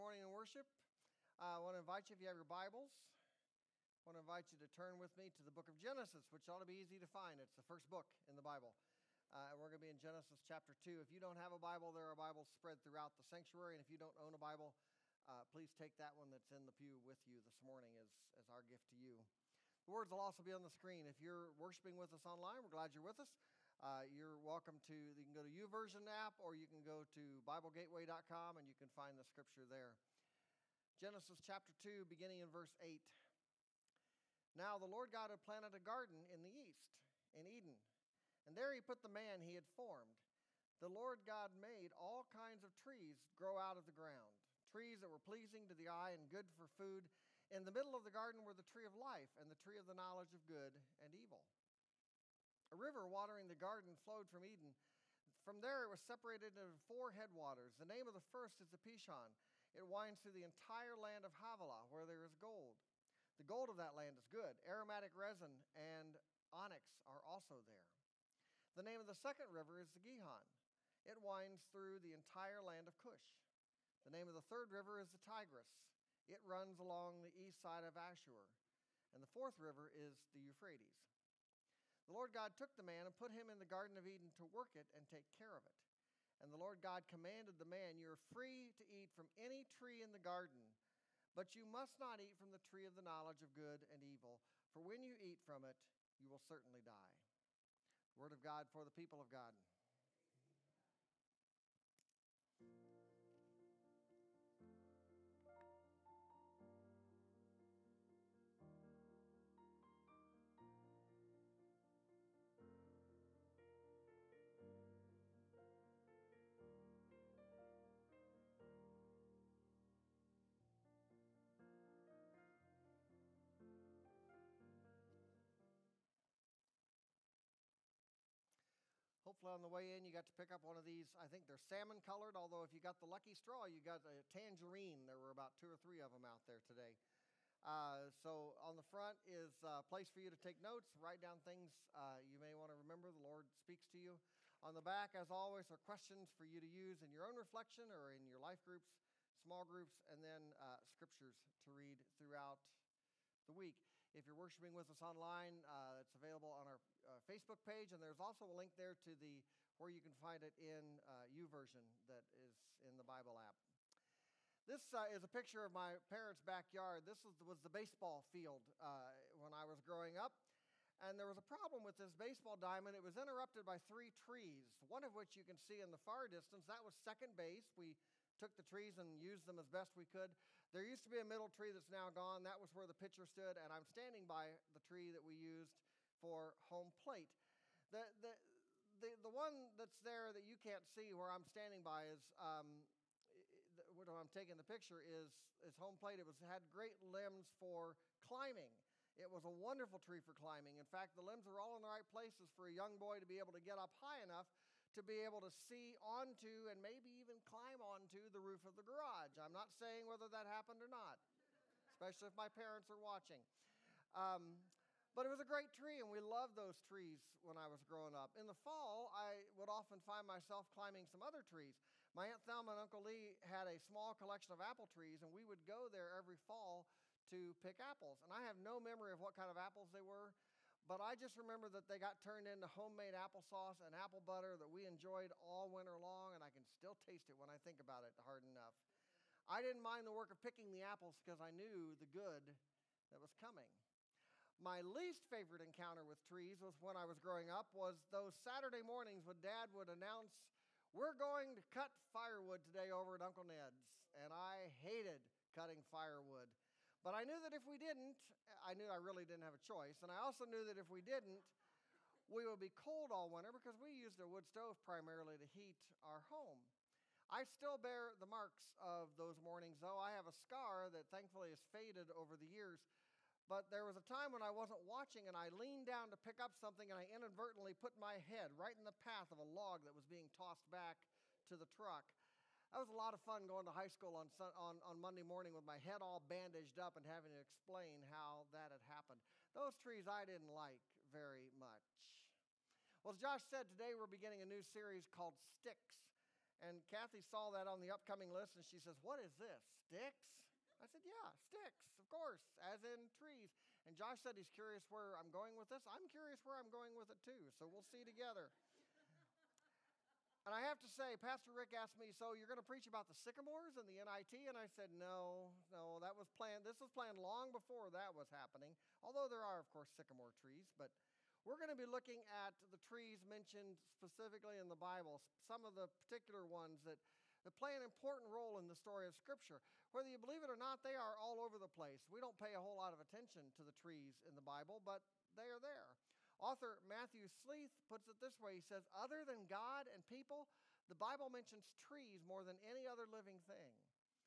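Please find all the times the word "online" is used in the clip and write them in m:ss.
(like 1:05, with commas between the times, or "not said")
0:22, 2:35.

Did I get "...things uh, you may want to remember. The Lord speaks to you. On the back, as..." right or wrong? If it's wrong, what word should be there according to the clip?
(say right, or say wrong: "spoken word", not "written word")
right.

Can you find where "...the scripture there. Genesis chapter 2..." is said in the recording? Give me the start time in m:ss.
0:29.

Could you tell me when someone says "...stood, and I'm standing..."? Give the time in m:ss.
3:03.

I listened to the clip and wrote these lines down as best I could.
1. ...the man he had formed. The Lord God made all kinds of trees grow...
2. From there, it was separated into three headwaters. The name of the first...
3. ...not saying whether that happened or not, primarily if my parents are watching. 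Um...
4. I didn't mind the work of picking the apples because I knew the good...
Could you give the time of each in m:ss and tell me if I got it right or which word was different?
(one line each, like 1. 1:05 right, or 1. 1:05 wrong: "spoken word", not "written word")
1. 0:39 right
2. 0:55 wrong: "four", not "three"
3. 3:29 wrong: "especially", not "primarily"
4. 3:59 right.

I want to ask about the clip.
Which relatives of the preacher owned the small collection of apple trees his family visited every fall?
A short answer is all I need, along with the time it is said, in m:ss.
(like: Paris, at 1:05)
Aunt Thelma and Uncle Lee, at 3:42.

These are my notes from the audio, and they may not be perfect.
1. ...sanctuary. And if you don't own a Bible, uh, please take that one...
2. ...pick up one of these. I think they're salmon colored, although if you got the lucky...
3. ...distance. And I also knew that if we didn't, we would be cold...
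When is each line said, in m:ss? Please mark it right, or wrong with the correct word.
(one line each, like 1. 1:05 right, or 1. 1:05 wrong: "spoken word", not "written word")
1. 0:13 right
2. 2:10 right
3. 4:19 wrong: "choice", not "distance".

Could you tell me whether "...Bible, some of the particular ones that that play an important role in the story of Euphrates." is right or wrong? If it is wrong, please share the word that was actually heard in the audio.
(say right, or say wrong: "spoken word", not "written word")
wrong: "Scripture", not "Euphrates".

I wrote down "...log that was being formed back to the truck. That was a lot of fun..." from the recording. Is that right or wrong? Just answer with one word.
wrong.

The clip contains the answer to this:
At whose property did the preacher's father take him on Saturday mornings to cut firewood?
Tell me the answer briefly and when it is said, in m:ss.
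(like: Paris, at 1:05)
Uncle Ned's, at 4:13.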